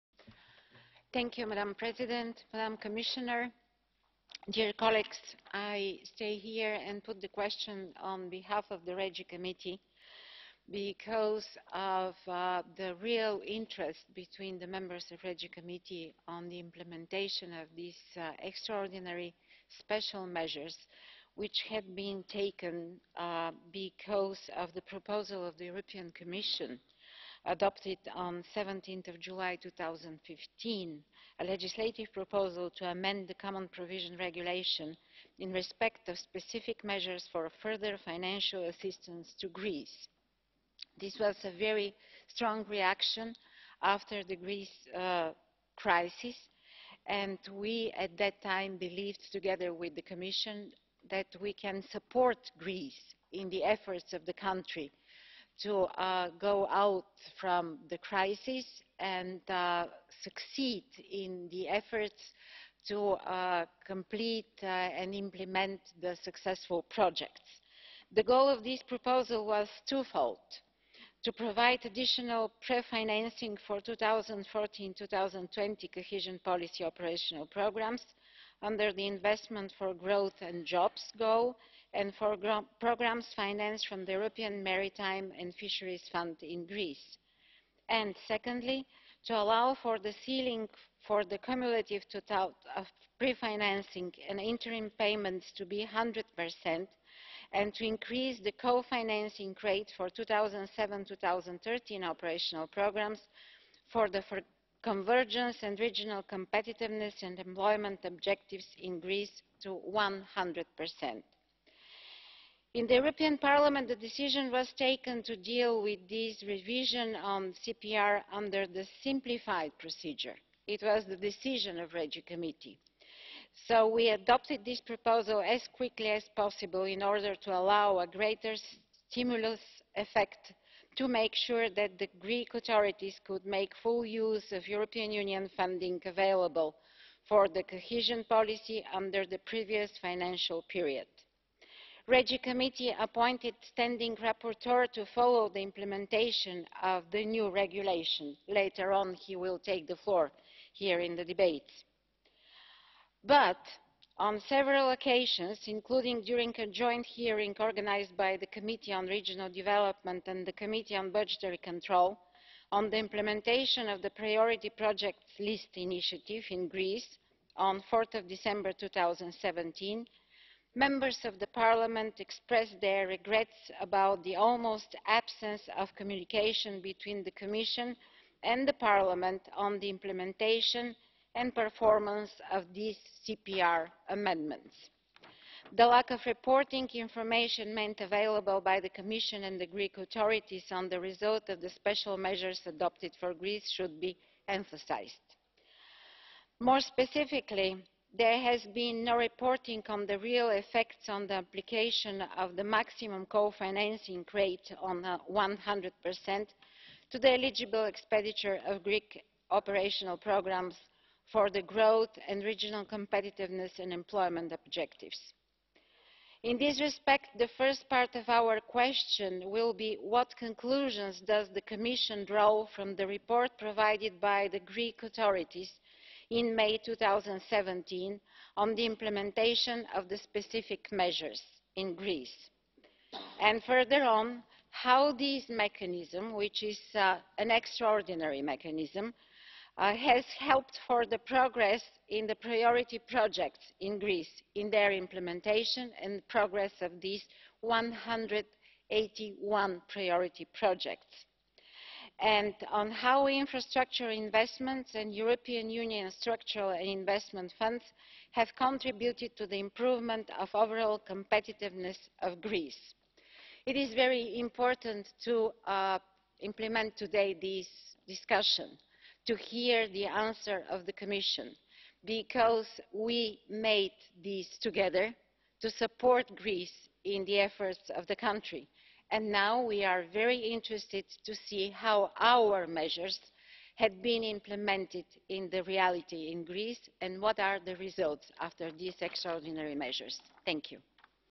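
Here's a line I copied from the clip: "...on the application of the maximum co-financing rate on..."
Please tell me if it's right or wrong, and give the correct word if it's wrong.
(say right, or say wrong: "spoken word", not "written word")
right.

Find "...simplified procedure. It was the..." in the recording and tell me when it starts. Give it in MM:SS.
01:59.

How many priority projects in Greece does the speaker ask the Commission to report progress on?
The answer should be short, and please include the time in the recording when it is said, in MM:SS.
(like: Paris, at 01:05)
181, at 04:07.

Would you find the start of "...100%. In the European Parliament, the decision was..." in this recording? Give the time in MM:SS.
01:49.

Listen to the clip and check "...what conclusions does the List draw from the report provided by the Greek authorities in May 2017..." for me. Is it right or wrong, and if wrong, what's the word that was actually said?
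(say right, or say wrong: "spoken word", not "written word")
wrong: "Commission", not "List".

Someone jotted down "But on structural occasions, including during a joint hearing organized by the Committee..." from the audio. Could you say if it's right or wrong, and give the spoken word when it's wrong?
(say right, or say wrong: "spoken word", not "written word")
wrong: "several", not "structural".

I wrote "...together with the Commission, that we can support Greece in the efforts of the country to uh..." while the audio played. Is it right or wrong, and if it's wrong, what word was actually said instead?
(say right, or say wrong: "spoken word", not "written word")
right.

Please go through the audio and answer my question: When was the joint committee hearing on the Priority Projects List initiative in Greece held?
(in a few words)
4 December 2017.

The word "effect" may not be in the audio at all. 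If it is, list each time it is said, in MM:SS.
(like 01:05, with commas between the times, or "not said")
02:09, 03:20.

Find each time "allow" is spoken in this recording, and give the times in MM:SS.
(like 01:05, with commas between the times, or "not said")
01:29, 02:07.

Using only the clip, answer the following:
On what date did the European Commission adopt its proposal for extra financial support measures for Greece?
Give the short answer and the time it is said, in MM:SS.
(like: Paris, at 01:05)
17 July 2015, at 00:28.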